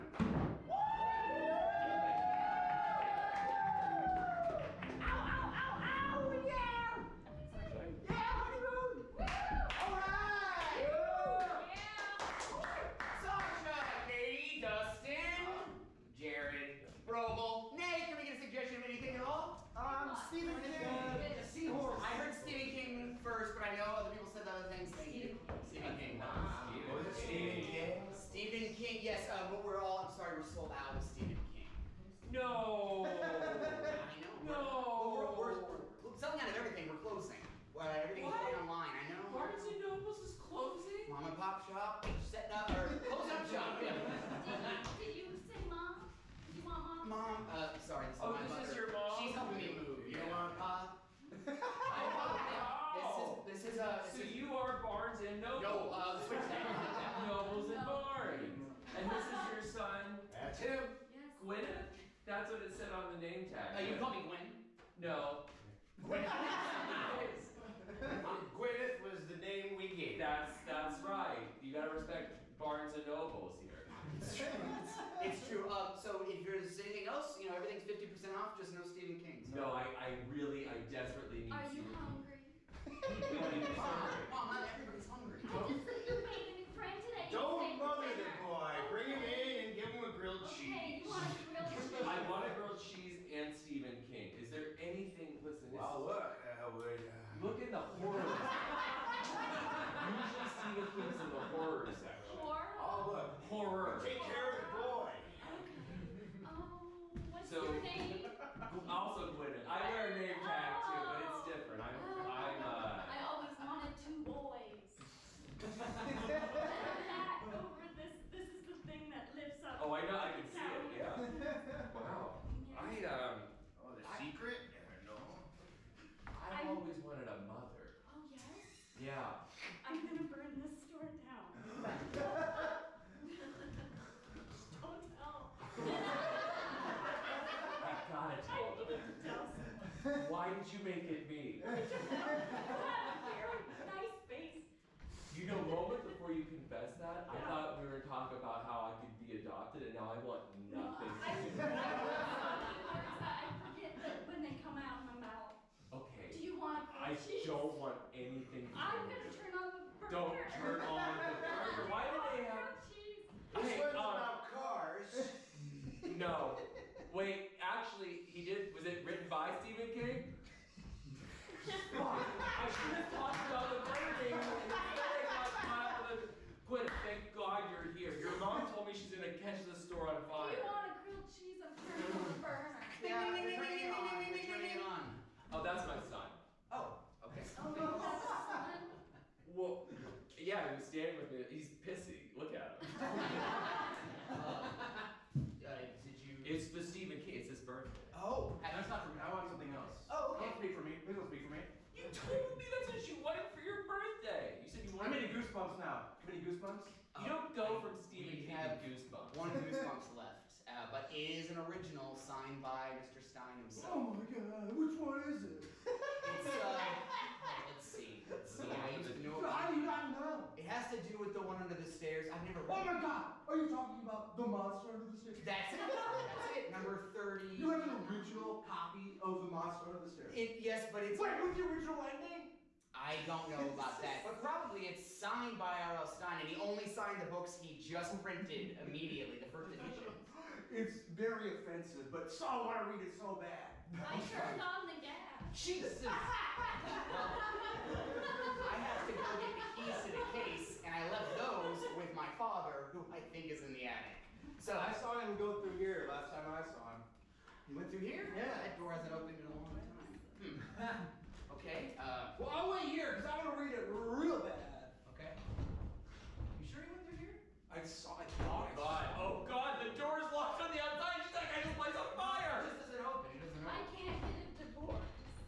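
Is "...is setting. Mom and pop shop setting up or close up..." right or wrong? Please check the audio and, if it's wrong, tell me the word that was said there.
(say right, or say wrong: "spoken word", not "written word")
wrong: "closing", not "setting".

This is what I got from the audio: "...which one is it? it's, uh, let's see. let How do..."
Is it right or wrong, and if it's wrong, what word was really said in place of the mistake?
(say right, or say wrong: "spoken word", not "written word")
right.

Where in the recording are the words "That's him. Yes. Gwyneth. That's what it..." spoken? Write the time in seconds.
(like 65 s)
60 s.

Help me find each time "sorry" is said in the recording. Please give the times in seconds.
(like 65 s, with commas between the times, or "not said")
47 s.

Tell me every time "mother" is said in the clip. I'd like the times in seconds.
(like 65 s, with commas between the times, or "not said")
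48 s, 127 s.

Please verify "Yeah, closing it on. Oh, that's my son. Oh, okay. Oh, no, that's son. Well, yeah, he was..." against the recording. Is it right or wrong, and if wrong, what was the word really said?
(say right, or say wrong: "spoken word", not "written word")
wrong: "turning", not "closing".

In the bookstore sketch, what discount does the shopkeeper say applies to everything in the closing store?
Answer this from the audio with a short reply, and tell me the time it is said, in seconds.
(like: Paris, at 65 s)
50 percent, at 77 s.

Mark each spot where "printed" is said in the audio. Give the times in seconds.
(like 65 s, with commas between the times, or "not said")
238 s.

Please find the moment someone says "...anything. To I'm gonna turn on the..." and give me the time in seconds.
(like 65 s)
158 s.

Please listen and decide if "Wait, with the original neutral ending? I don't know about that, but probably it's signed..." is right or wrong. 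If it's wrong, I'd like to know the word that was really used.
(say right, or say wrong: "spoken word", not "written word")
right.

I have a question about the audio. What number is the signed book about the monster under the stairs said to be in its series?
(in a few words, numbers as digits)
30.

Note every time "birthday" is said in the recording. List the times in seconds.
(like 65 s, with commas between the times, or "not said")
197 s, 203 s.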